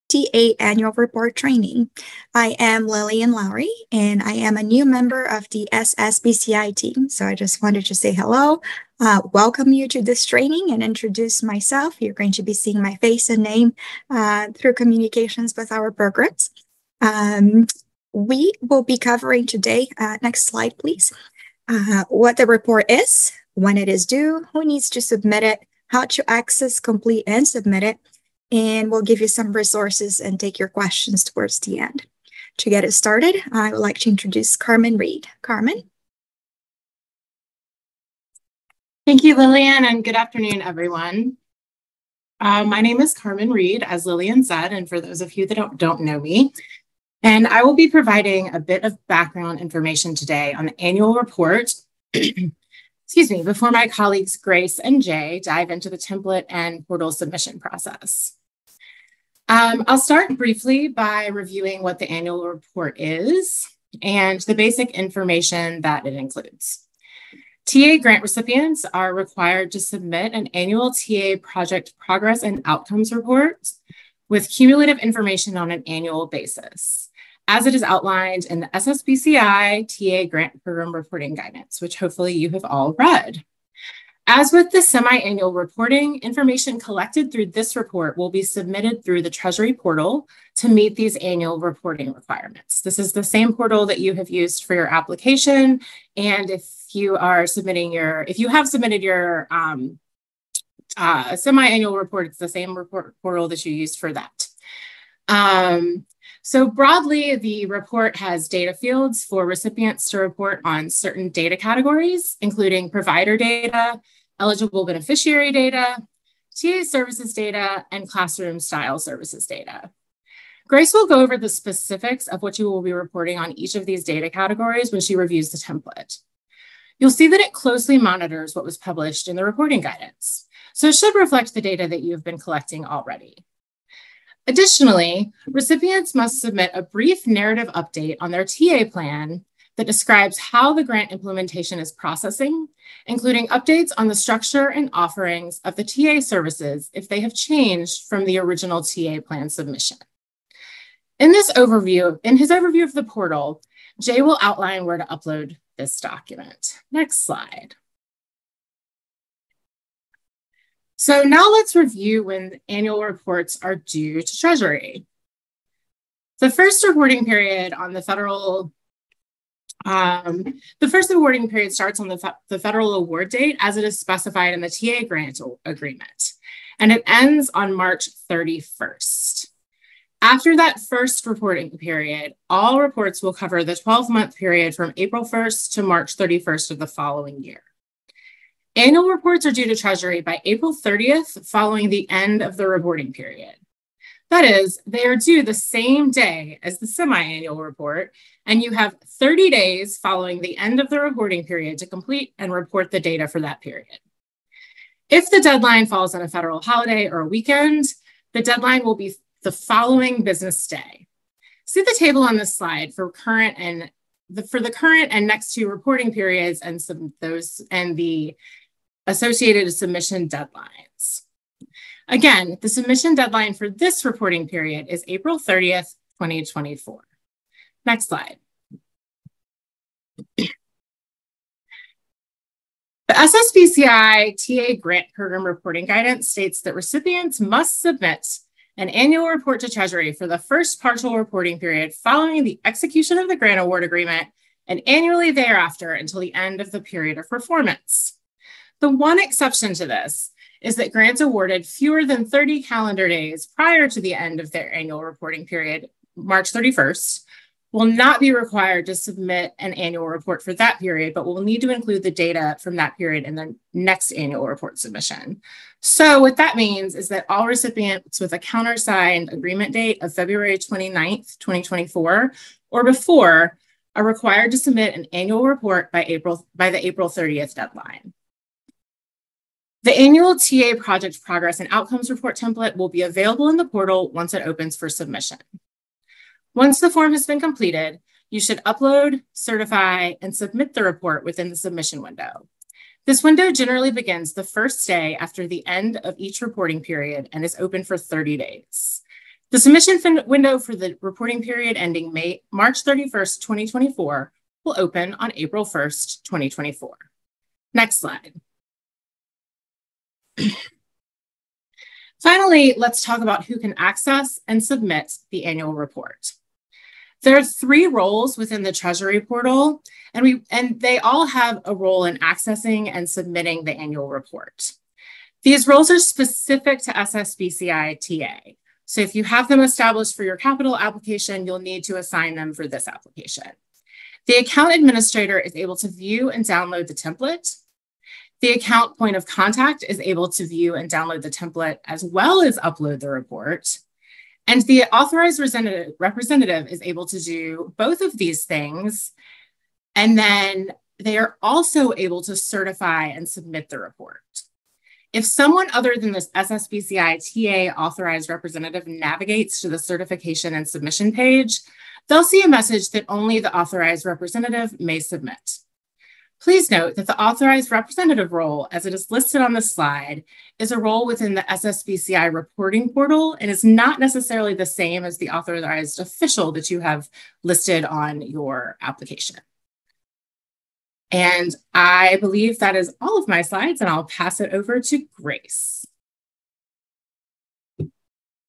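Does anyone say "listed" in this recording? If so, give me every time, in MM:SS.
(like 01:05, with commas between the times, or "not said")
06:09, 06:17.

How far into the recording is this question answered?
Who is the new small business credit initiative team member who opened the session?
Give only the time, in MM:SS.
00:02.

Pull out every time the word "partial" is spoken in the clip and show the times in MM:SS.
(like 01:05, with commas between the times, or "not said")
04:00.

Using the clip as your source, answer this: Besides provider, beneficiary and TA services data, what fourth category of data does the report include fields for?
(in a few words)
classroom style services data.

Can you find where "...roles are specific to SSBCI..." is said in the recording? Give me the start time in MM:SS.
05:25.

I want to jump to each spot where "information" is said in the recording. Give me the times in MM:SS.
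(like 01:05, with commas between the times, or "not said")
00:49, 01:04, 01:14, 01:26.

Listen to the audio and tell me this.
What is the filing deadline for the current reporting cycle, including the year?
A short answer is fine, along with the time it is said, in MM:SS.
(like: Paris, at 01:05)
April 30th, 2024, at 03:45.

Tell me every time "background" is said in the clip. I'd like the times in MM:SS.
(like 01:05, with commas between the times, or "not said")
00:49.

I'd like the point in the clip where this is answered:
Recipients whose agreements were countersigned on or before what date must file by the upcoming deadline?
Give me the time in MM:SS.
04:30.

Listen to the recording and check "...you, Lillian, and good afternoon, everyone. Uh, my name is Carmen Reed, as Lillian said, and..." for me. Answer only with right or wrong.
right.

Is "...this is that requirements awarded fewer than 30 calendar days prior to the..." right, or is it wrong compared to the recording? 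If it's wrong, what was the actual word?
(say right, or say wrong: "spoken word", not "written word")
wrong: "grants", not "requirements".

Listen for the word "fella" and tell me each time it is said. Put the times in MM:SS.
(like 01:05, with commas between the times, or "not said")
not said.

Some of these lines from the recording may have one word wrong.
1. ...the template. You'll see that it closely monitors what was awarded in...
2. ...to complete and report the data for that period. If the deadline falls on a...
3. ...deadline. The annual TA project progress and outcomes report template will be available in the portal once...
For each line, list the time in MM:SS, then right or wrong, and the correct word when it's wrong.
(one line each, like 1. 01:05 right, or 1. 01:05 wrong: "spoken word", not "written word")
1. 02:05 wrong: "published", not "awarded"
2. 03:21 right
3. 04:37 right.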